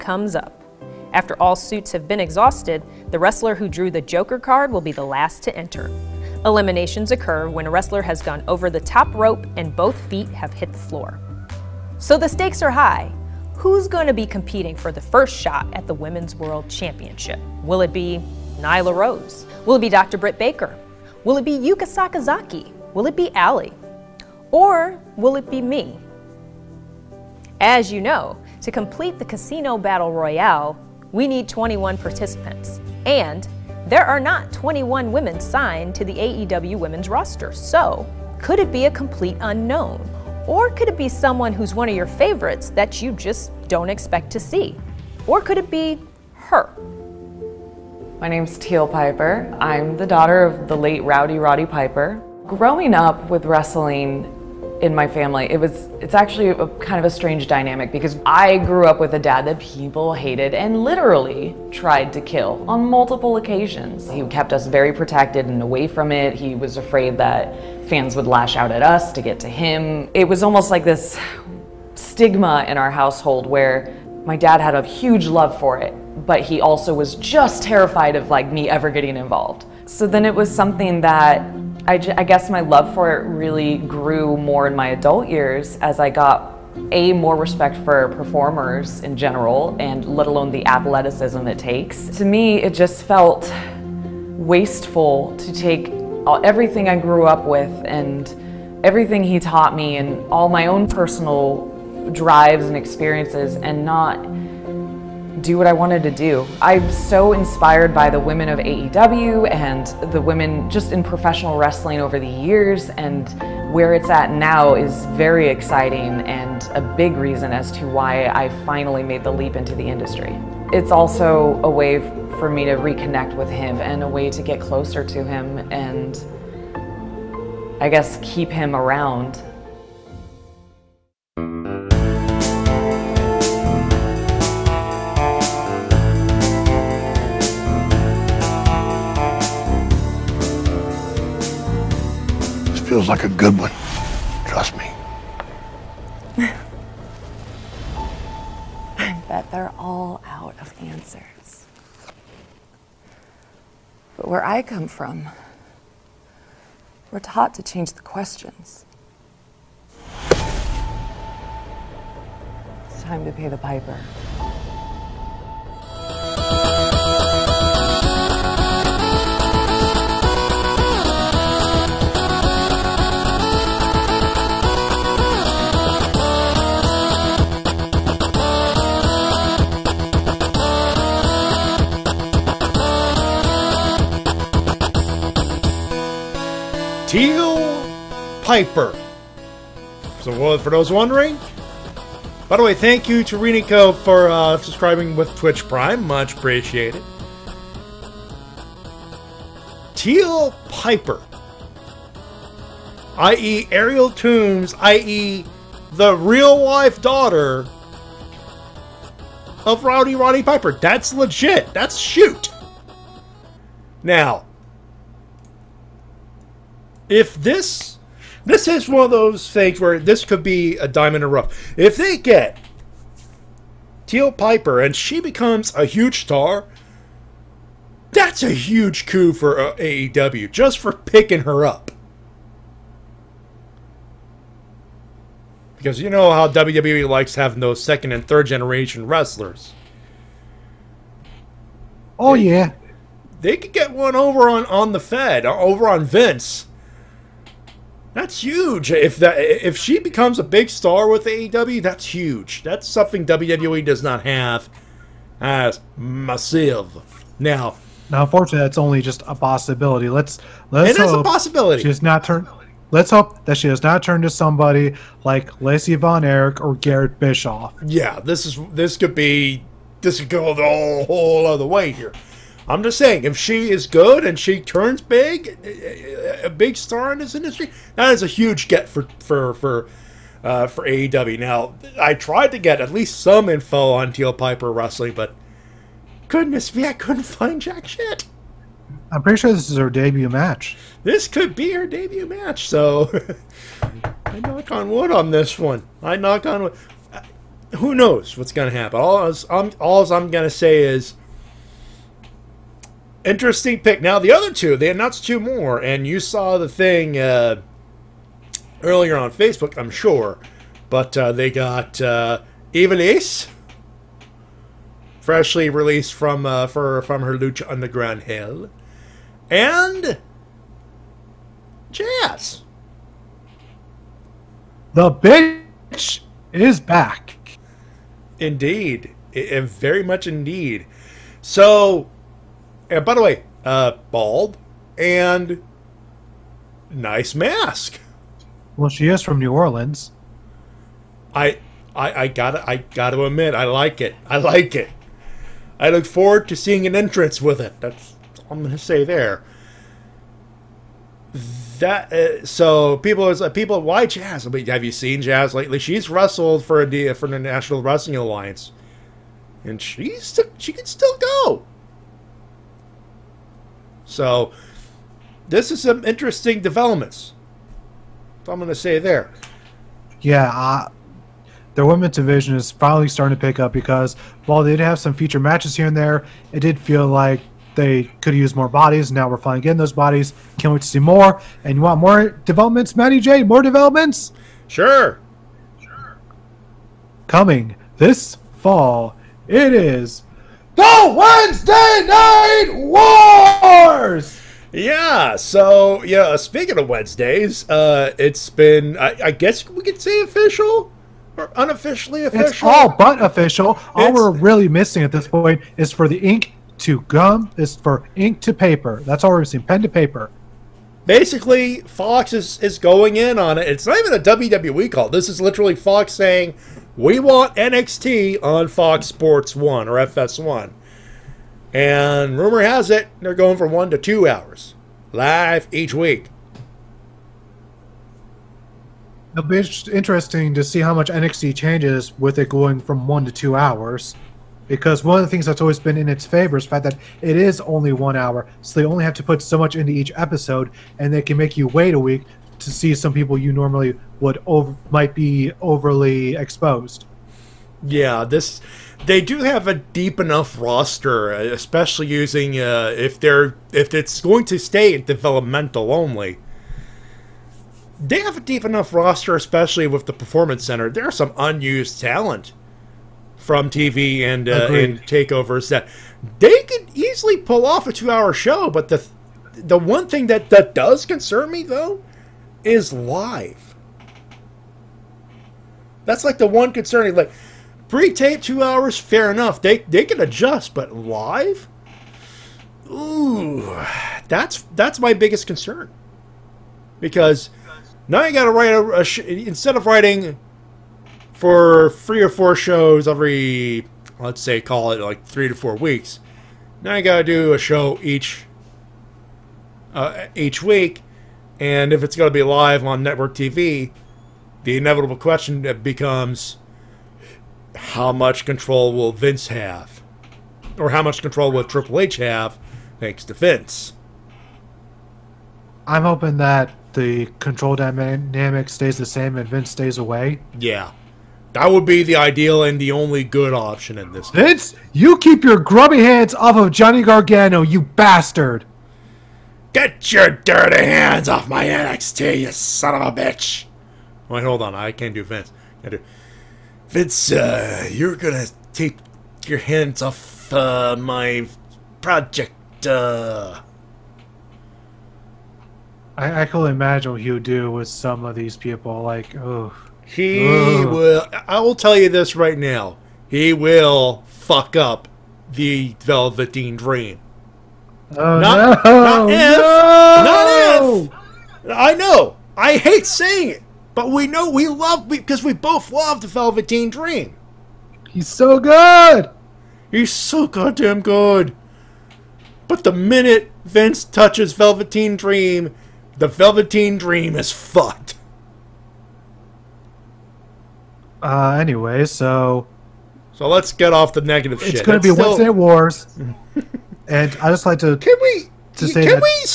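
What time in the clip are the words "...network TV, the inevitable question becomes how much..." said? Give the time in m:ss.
8:23.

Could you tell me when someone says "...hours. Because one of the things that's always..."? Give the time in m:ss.
7:13.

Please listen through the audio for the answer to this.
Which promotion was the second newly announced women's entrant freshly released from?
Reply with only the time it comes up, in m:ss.
5:17.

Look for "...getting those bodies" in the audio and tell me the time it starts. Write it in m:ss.
6:19.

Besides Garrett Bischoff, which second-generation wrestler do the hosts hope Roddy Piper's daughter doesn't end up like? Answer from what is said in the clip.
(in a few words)
Lacey Von Erich.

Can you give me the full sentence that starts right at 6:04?
So this is some interesting developments.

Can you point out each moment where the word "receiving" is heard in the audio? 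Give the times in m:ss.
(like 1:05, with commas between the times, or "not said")
not said.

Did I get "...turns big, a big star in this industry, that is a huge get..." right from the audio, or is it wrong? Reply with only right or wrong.
right.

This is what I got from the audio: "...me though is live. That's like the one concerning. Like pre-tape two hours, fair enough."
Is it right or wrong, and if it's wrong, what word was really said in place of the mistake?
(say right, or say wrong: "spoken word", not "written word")
right.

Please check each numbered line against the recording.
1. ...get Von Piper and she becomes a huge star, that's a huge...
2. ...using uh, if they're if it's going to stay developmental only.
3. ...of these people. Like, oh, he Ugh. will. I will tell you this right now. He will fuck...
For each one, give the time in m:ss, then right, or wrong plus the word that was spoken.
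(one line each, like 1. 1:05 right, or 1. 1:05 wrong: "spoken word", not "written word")
1. 3:42 wrong: "Teal", not "Von"
2. 7:32 right
3. 9:08 right.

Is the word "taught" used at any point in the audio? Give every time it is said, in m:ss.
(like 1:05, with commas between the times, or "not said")
1:39, 2:37.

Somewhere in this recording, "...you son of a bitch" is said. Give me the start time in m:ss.
8:52.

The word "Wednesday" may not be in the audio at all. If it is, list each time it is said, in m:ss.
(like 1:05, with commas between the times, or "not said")
6:31, 6:36, 9:45.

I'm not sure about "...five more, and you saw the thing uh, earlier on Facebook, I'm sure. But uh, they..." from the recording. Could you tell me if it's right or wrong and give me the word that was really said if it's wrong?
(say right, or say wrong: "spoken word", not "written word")
wrong: "two", not "five".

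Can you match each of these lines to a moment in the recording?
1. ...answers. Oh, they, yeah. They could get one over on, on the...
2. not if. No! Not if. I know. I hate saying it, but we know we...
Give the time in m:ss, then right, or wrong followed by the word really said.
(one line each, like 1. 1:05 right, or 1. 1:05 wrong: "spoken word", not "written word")
1. 3:59 wrong: "wrestlers", not "answers"
2. 9:20 right.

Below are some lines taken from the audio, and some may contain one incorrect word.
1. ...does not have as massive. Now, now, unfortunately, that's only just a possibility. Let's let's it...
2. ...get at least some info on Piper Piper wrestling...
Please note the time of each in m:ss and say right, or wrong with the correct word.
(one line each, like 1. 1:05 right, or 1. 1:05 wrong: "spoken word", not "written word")
1. 4:13 right
2. 4:42 wrong: "Teal", not "Piper".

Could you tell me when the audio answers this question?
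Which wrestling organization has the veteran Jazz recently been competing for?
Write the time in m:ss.
5:57.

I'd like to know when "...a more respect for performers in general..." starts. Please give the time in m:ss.
1:26.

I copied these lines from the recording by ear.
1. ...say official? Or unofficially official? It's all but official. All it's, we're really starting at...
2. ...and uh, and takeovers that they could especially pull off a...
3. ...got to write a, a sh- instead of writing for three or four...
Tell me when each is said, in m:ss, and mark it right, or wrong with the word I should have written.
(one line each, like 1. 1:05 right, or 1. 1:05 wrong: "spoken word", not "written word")
1. 6:40 wrong: "missing", not "starting"
2. 7:44 wrong: "easily", not "especially"
3. 8:08 right.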